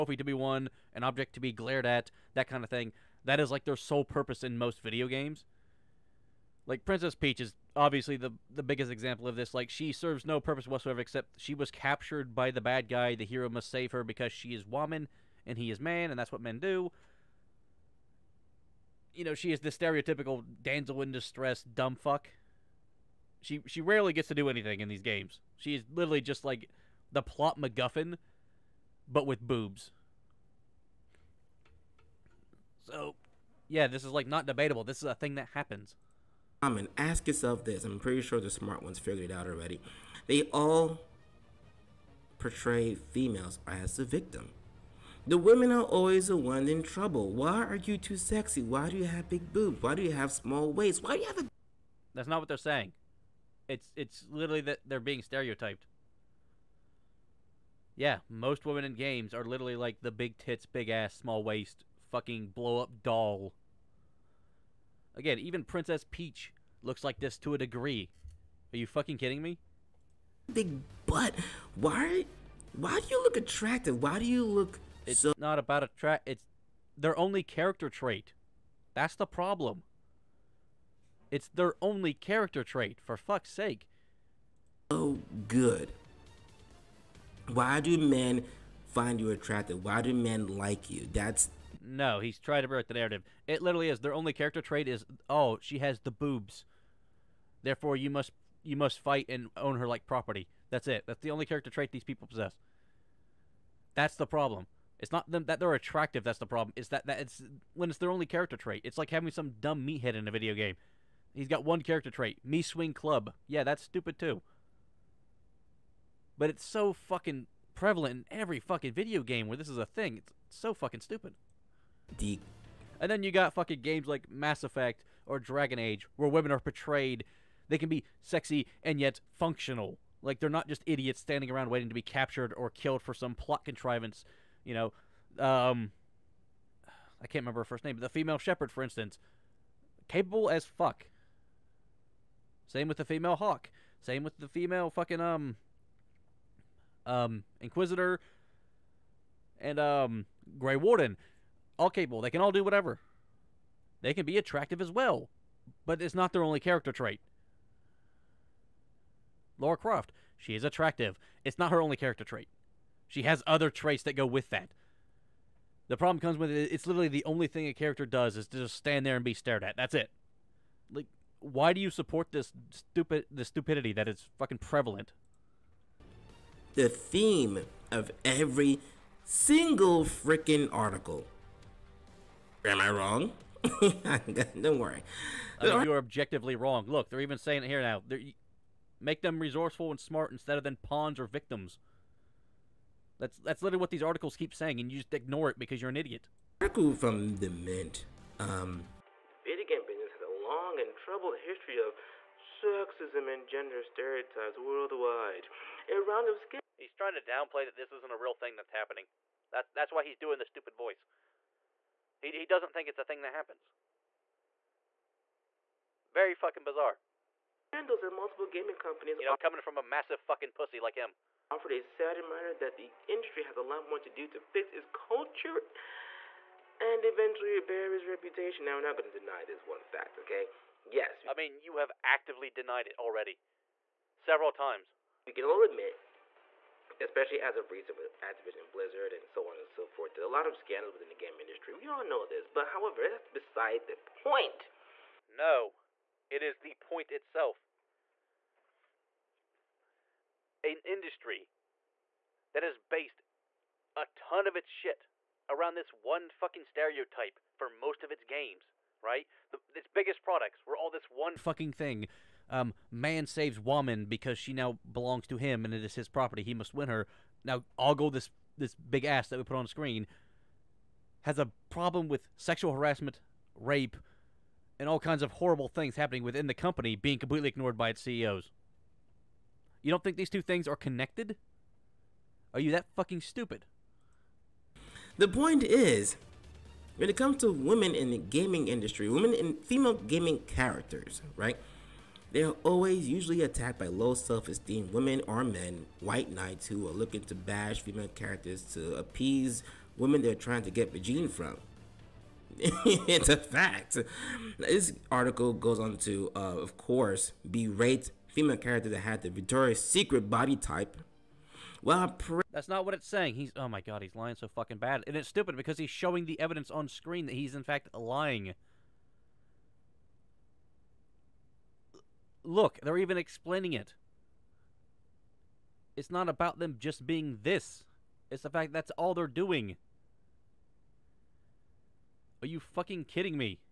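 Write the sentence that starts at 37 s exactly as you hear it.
I'm pretty sure the smart ones figured it out already.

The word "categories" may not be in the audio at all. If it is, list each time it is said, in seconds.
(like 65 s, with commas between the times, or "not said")
not said.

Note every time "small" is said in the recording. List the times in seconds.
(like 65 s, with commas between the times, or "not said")
50 s, 61 s.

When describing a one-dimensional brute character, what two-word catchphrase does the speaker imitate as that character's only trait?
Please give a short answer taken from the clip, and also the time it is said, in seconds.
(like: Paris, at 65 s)
Me swing club, at 112 s.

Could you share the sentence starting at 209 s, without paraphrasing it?
That's that's why he's doing the stupid voice.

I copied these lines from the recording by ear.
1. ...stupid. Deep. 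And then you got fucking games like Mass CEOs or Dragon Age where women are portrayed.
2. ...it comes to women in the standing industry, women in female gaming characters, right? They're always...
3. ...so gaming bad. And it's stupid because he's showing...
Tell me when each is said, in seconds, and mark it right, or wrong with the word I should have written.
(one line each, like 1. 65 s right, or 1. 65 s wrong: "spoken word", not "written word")
1. 121 s wrong: "Effect", not "CEOs"
2. 287 s wrong: "gaming", not "standing"
3. 314 s wrong: "fucking", not "gaming".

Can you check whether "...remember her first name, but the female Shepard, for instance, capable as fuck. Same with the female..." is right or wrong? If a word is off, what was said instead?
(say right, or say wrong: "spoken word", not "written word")
right.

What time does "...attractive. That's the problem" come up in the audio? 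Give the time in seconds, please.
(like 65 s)
105 s.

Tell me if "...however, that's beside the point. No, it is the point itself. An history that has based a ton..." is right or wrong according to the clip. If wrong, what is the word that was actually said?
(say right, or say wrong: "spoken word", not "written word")
wrong: "industry", not "history".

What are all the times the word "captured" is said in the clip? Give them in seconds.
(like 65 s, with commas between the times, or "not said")
11 s, 132 s.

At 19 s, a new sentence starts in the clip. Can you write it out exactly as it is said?
You know, she is the stereotypical damsel in distress dumb fuck.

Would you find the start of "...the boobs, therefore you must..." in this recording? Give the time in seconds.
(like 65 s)
95 s.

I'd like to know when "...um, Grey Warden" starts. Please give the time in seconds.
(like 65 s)
149 s.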